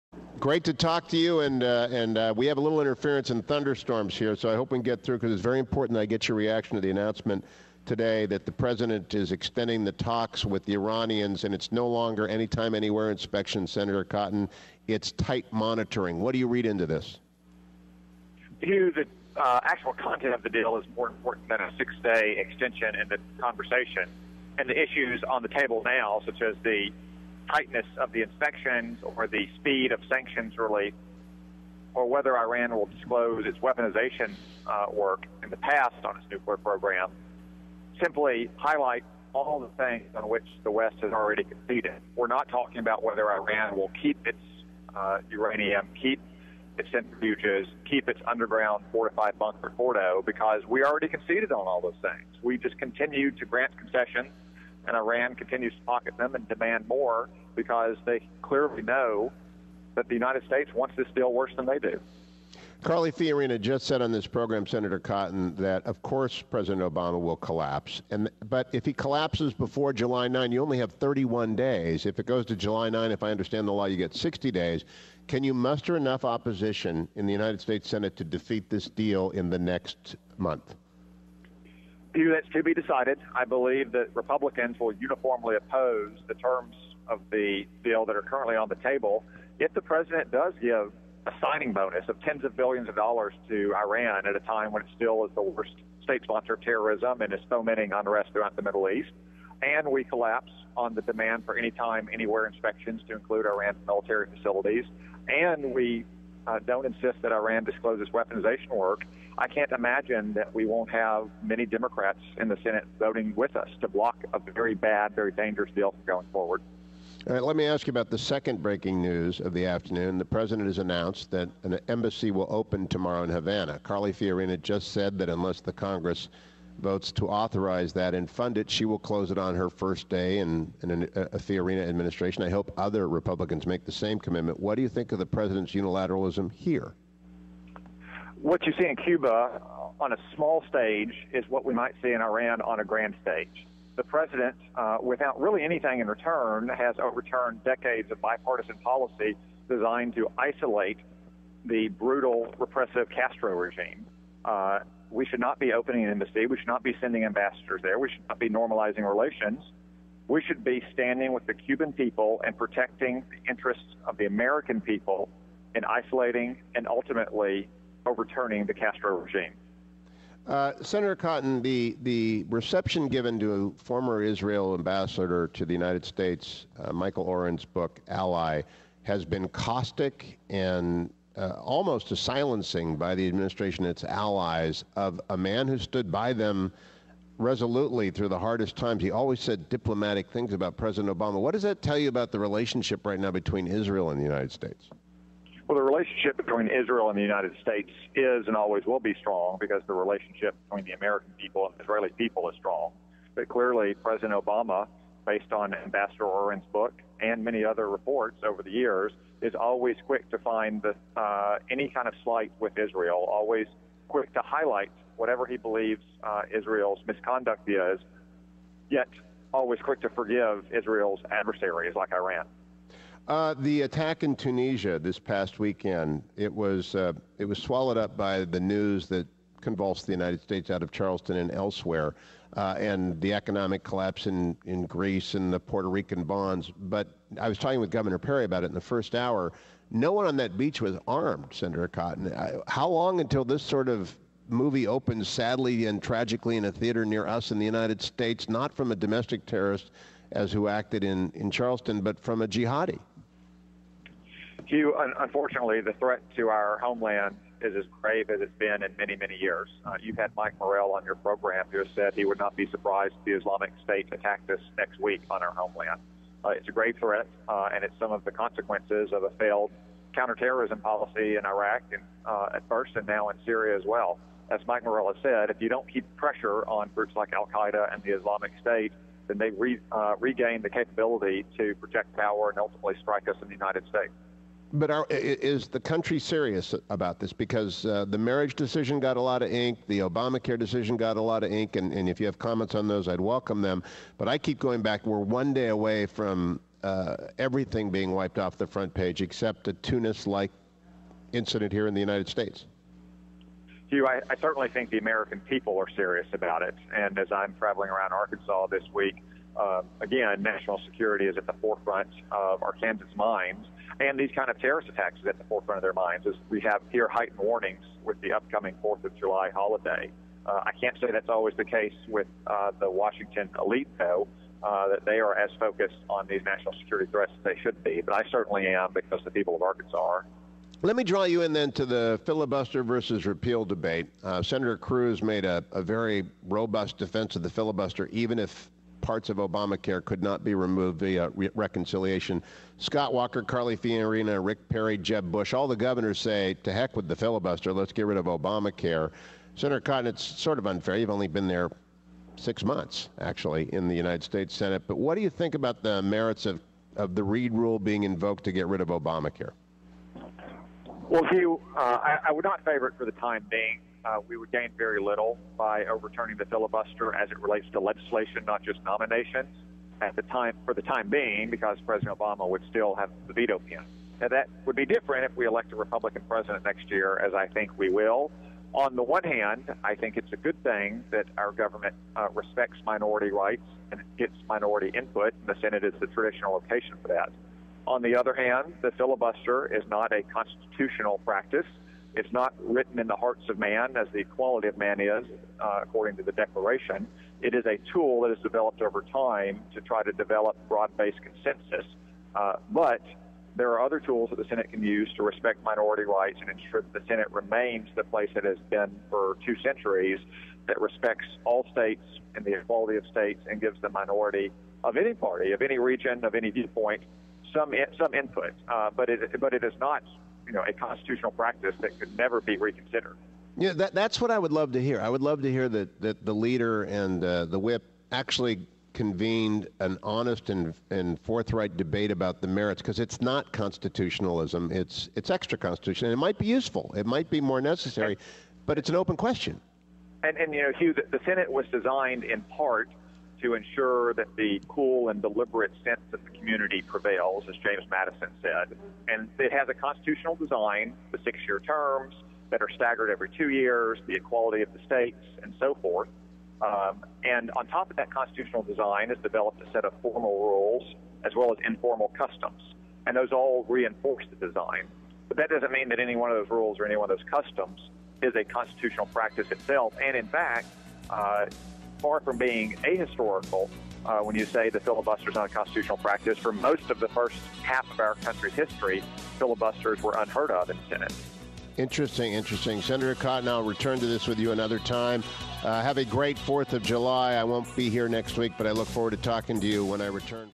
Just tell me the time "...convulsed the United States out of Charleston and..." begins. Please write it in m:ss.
3:49.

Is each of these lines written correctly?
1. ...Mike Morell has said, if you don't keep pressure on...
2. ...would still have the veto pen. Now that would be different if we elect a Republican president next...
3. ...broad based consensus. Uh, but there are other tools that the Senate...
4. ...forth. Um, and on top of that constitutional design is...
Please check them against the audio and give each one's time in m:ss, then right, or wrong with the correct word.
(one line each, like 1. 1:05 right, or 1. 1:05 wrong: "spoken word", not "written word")
1. 4:34 right
2. 6:12 right
3. 6:40 right
4. 7:35 right.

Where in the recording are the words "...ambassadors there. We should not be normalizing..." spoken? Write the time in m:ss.
2:37.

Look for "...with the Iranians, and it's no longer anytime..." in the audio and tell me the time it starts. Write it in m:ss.
0:10.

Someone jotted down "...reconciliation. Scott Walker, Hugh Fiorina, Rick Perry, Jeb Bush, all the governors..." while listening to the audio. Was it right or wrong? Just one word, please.
wrong.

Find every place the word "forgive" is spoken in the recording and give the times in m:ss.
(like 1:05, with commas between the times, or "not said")
3:40.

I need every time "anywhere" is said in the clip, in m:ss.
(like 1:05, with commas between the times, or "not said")
0:12, 1:42.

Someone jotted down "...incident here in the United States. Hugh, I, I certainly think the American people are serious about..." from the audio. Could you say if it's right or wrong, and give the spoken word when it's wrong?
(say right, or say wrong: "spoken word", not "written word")
right.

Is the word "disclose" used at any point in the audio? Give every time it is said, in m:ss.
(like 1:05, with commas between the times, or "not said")
0:32, 1:47.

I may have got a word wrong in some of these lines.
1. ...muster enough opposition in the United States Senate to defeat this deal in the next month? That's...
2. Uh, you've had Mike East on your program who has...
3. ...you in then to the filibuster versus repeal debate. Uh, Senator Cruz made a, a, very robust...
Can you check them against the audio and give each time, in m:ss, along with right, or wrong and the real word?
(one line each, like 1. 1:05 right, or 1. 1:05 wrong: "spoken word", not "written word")
1. 1:15 right
2. 4:19 wrong: "Morell", not "East"
3. 5:31 right.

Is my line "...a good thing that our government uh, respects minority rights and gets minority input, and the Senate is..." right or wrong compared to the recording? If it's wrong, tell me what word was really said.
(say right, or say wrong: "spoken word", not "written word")
right.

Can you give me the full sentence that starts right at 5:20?
Uh, I can't say that's always the case with uh, the Washington elite, though.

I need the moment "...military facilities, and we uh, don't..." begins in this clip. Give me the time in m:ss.
1:43.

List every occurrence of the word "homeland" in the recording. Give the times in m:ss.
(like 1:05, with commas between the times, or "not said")
4:16, 4:25.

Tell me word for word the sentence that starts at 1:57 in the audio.
All right, let me ask you about the second breaking news of the afternoon.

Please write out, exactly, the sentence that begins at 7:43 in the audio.
And those all reinforce the design.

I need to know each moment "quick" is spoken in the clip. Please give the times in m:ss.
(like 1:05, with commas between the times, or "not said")
3:30, 3:34, 3:39.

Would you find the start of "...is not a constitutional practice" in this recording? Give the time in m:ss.
6:29.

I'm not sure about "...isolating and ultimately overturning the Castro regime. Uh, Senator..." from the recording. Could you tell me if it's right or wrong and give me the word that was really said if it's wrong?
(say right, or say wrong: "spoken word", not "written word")
right.